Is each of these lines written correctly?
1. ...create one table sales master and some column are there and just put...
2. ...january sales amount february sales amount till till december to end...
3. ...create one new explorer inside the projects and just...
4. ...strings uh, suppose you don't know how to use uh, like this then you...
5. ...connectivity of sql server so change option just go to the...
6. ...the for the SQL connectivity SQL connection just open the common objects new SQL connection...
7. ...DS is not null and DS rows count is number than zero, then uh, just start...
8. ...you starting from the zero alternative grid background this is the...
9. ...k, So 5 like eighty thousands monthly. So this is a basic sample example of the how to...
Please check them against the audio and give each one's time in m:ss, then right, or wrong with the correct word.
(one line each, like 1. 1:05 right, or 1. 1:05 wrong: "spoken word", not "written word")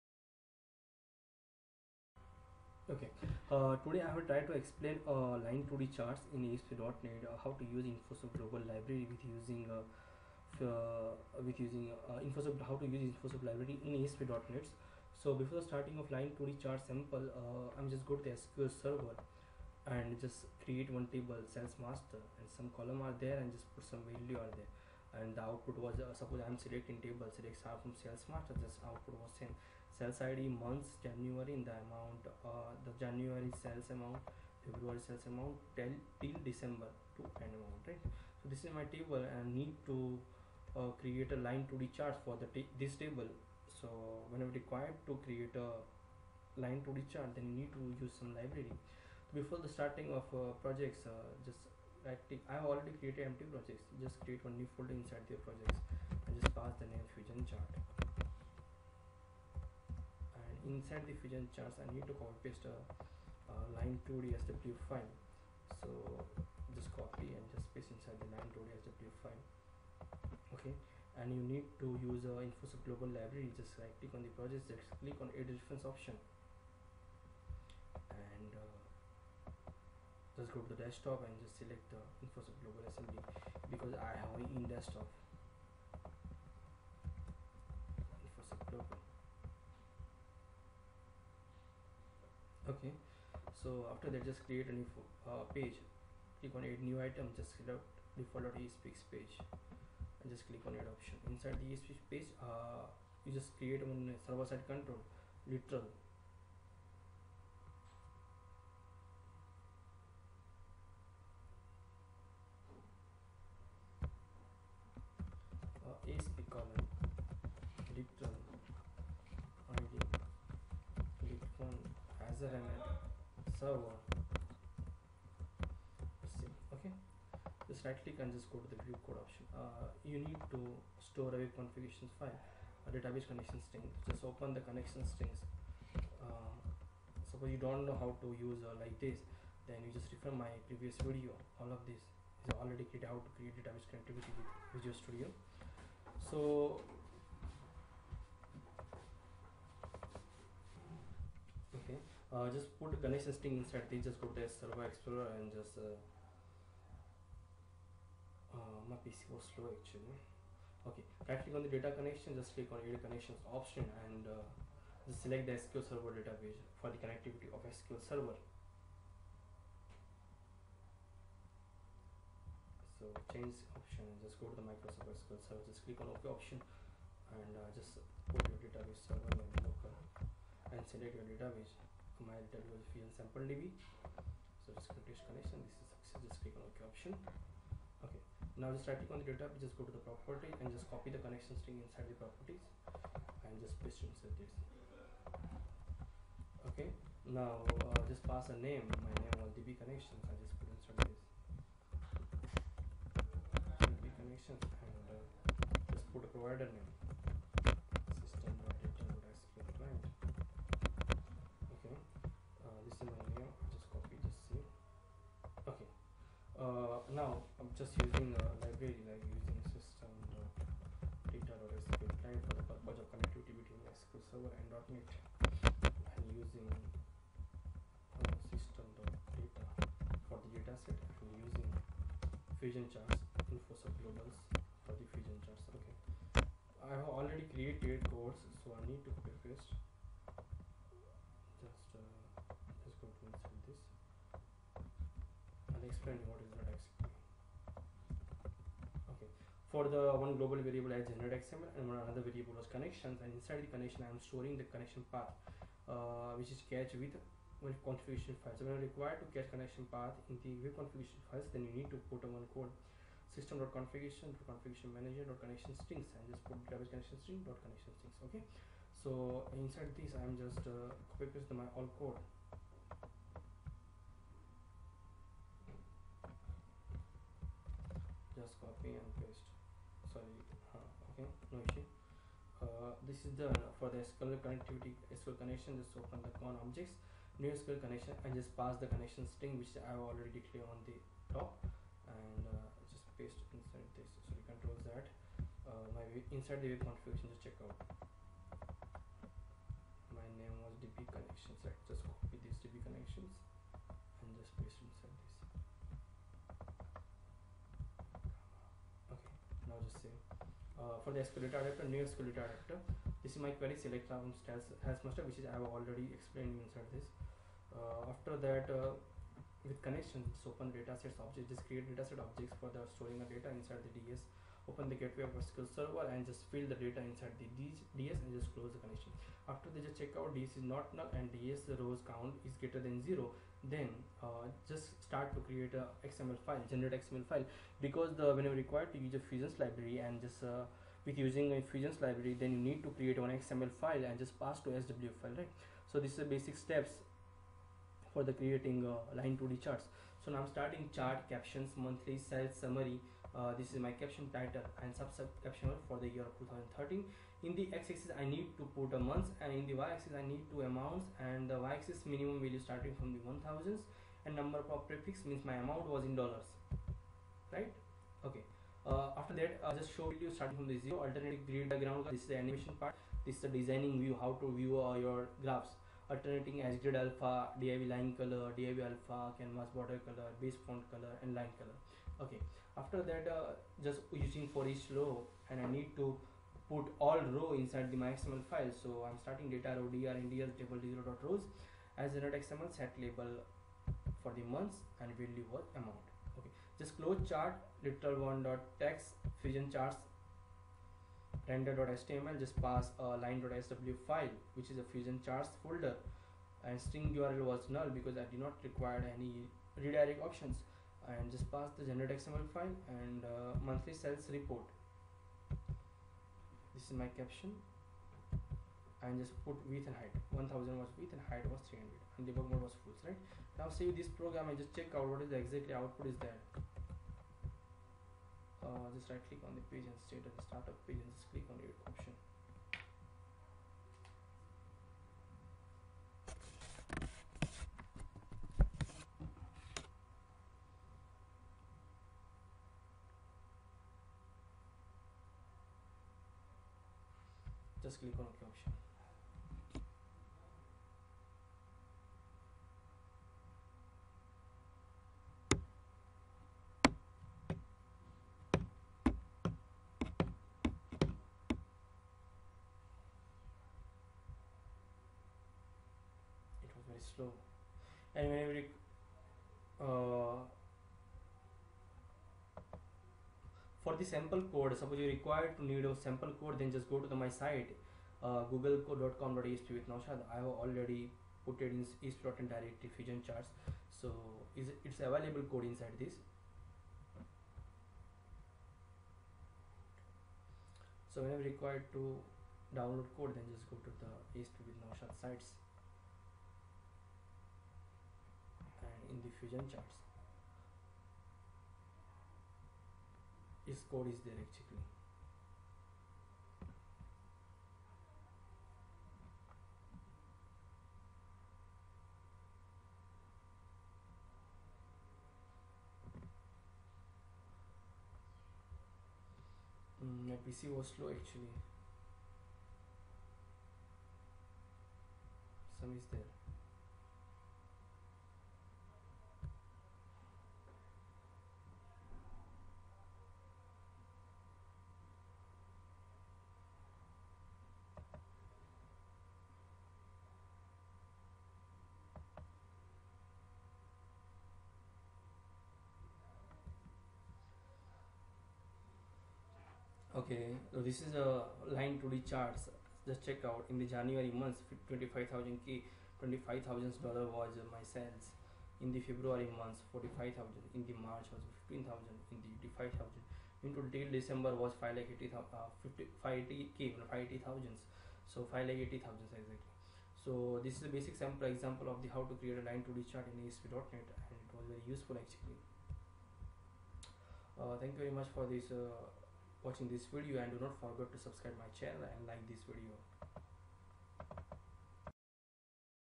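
1. 0:20 right
2. 0:32 right
3. 0:54 wrong: "folder", not "explorer"
4. 2:15 right
5. 2:47 right
6. 4:43 right
7. 5:30 wrong: "greater", not "number"
8. 6:10 right
9. 9:25 wrong: "exactly", not "monthly".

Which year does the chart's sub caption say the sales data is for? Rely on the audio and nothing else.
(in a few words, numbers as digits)
2013.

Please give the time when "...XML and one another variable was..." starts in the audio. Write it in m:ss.
4:11.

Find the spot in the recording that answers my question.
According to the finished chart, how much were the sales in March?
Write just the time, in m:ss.
9:21.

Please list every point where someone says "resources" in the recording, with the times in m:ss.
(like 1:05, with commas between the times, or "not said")
not said.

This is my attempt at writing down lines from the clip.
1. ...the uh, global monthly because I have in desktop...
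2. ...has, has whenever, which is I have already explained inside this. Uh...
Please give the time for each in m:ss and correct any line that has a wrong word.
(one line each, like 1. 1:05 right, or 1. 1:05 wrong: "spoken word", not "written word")
1. 1:21 wrong: "assembly", not "monthly"
2. 5:14 wrong: "master", not "whenever".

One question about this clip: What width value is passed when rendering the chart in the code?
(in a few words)
1000.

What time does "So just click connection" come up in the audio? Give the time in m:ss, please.
3:04.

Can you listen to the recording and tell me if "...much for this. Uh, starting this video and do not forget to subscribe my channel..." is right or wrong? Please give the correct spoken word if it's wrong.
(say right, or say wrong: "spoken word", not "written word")
wrong: "watching", not "starting".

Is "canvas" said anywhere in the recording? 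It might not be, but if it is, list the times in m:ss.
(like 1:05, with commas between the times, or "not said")
6:19.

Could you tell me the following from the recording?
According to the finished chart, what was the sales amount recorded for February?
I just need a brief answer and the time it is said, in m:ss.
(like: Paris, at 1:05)
45,000, at 9:19.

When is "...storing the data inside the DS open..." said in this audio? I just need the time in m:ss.
5:22.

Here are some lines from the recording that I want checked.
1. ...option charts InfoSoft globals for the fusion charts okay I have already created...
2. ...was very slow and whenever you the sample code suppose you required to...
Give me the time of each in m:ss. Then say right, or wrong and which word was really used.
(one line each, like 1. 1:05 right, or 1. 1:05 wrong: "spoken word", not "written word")
1. 3:52 wrong: "fusion", not "option"
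2. 7:46 right.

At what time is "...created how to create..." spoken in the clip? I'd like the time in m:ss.
2:22.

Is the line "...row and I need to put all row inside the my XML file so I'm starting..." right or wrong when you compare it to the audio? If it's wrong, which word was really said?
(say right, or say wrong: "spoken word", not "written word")
right.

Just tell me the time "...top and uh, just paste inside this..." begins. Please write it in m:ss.
4:51.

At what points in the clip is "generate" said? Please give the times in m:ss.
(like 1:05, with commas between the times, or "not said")
4:11, 5:36, 6:51.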